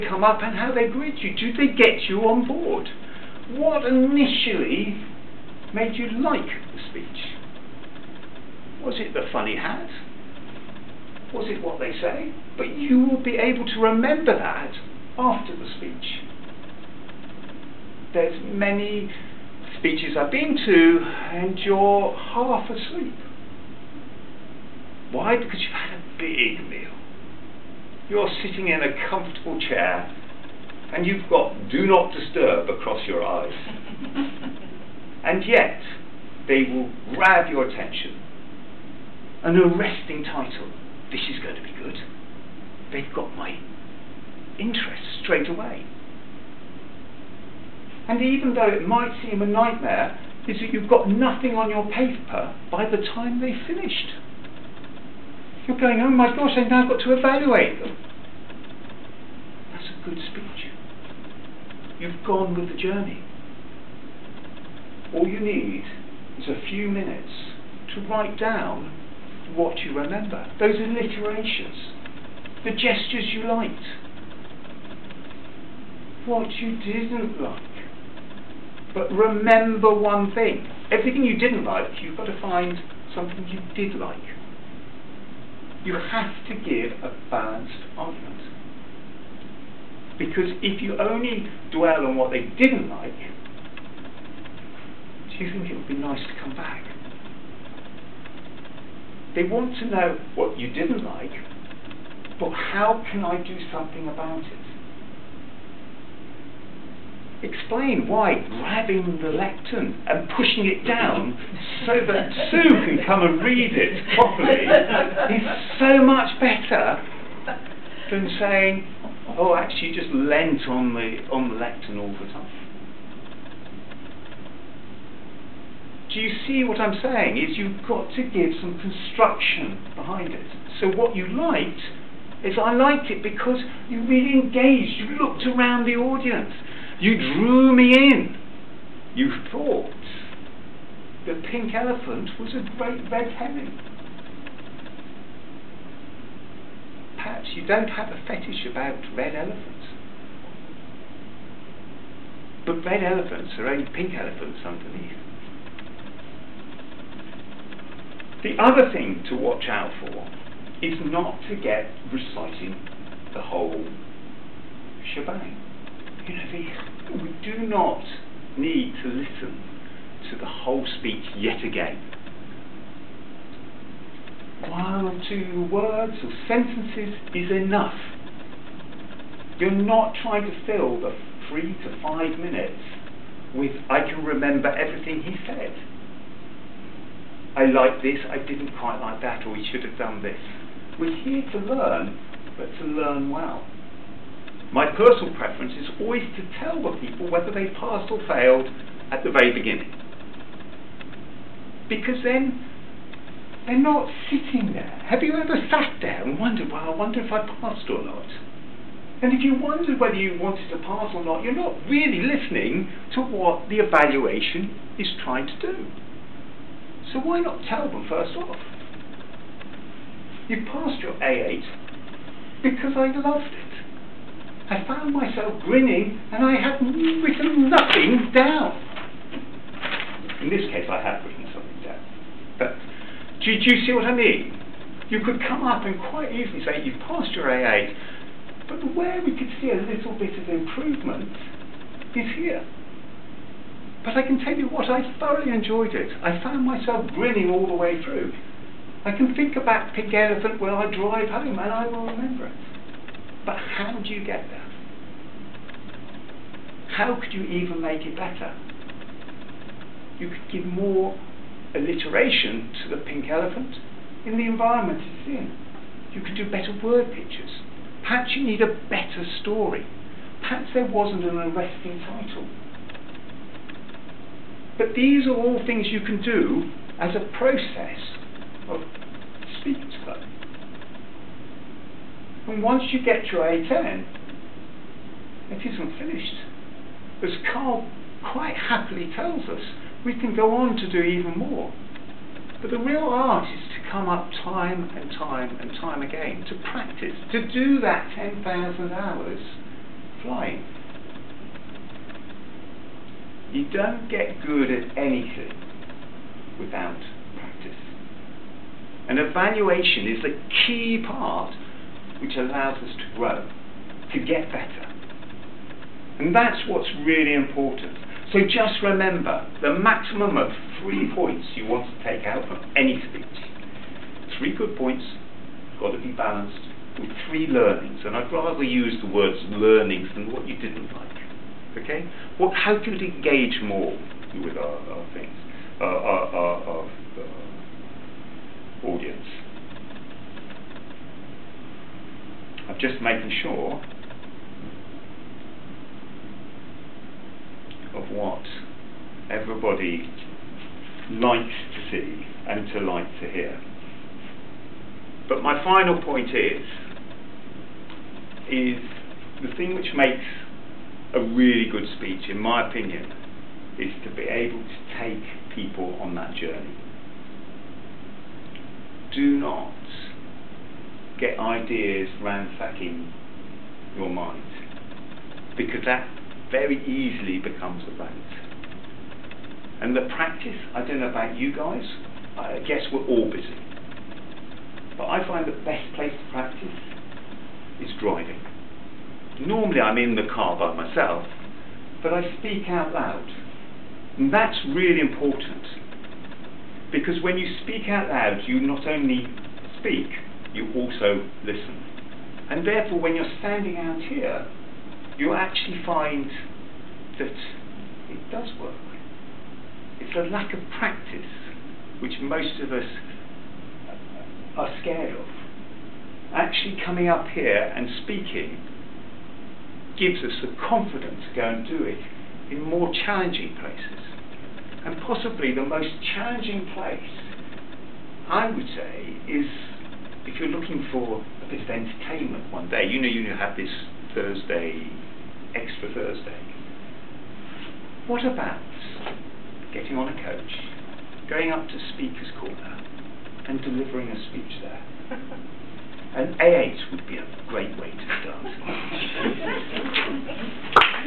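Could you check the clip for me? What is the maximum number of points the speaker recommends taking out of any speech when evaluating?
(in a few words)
3.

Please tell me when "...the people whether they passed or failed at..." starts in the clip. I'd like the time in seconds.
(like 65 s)
196 s.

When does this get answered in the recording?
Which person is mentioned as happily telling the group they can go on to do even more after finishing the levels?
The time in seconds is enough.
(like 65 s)
287 s.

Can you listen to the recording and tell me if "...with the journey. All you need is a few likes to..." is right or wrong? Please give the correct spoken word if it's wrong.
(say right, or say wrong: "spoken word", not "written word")
wrong: "minutes", not "likes".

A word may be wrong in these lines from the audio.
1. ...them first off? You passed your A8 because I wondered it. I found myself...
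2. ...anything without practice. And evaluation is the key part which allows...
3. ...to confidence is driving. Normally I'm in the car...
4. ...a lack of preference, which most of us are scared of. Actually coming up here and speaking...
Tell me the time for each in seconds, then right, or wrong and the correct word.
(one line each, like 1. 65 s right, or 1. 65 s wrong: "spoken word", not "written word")
1. 217 s wrong: "loved", not "wondered"
2. 304 s right
3. 386 s wrong: "practice", not "confidence"
4. 410 s wrong: "practice", not "preference".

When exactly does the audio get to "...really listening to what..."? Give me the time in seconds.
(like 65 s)
211 s.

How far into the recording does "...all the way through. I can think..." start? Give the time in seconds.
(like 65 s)
247 s.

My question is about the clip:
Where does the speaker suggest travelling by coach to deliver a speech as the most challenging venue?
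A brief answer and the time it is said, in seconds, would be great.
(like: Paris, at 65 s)
Speaker's Corner, at 441 s.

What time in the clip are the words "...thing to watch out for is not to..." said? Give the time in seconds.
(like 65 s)
158 s.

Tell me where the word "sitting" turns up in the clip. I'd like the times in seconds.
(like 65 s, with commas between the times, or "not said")
28 s, 204 s.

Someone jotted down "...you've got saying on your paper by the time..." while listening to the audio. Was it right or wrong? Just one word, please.
wrong.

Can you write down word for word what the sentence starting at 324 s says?
Three good points, got to be balanced with three learnings.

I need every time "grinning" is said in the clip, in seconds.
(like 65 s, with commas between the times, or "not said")
225 s, 247 s.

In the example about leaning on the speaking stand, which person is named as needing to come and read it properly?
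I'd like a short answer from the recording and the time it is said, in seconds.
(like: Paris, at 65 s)
Sue, at 112 s.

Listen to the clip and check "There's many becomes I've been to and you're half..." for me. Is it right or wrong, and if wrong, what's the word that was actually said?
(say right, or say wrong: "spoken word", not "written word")
wrong: "speeches", not "becomes".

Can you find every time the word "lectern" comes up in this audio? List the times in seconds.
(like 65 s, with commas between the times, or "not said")
109 s, 121 s.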